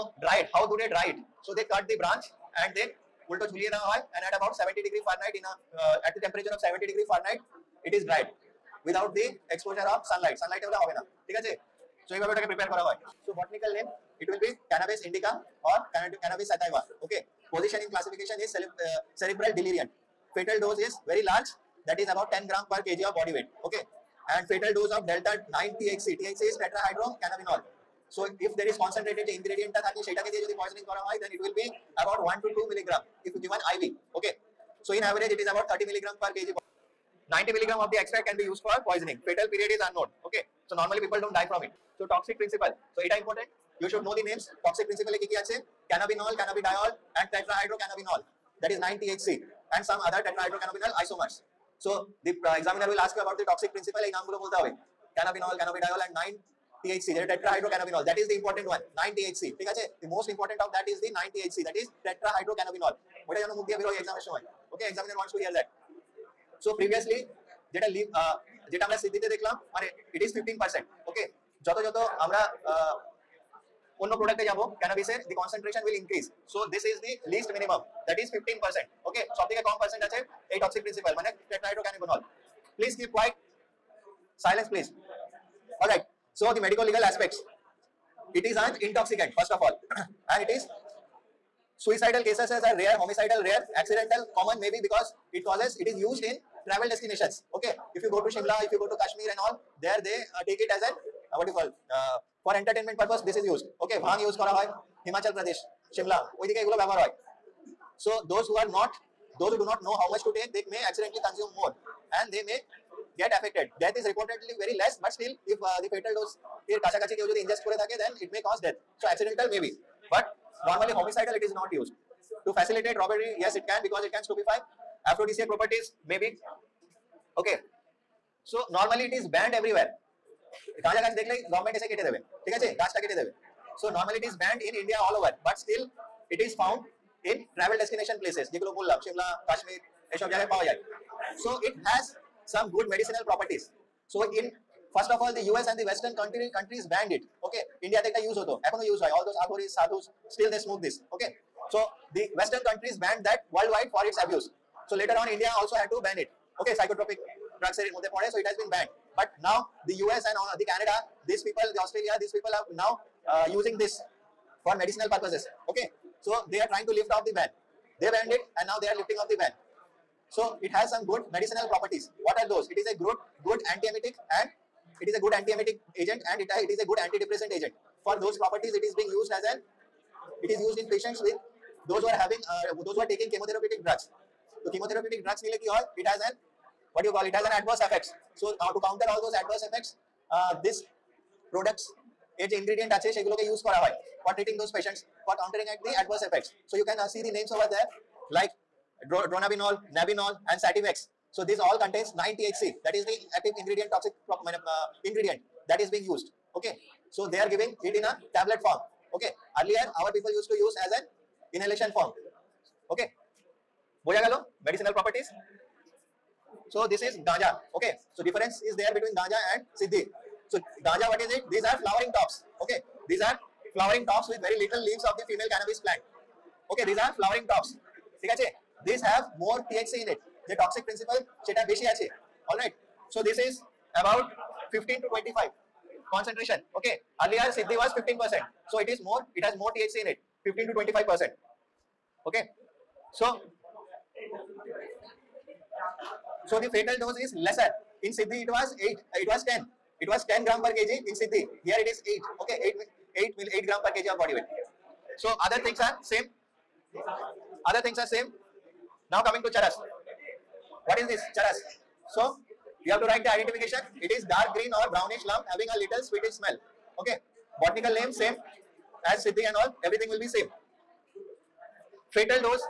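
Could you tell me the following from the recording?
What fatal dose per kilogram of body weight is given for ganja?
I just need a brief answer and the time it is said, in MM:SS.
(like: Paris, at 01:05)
8 grams per kg, at 04:13.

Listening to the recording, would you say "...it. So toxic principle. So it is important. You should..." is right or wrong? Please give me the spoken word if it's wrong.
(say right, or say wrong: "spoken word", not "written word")
right.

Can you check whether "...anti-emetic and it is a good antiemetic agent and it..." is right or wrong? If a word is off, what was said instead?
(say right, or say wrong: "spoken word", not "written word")
right.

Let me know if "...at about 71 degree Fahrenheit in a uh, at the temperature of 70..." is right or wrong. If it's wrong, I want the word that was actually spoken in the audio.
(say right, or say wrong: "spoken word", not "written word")
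wrong: "70", not "71".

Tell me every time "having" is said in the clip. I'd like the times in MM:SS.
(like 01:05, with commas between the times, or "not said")
03:02, 04:25.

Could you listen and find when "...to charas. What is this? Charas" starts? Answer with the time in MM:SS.
04:19.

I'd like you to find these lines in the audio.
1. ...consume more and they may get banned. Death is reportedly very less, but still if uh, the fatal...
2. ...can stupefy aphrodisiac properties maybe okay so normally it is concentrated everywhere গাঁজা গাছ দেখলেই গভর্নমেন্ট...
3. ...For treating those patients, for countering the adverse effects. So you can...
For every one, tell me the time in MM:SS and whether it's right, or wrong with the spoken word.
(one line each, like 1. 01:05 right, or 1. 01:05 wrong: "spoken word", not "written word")
1. 01:51 wrong: "affected", not "banned"
2. 02:04 wrong: "banned", not "concentrated"
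3. 03:14 right.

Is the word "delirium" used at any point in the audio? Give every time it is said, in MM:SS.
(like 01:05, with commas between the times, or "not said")
00:19.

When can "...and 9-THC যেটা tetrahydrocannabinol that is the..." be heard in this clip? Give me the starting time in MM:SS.
00:56.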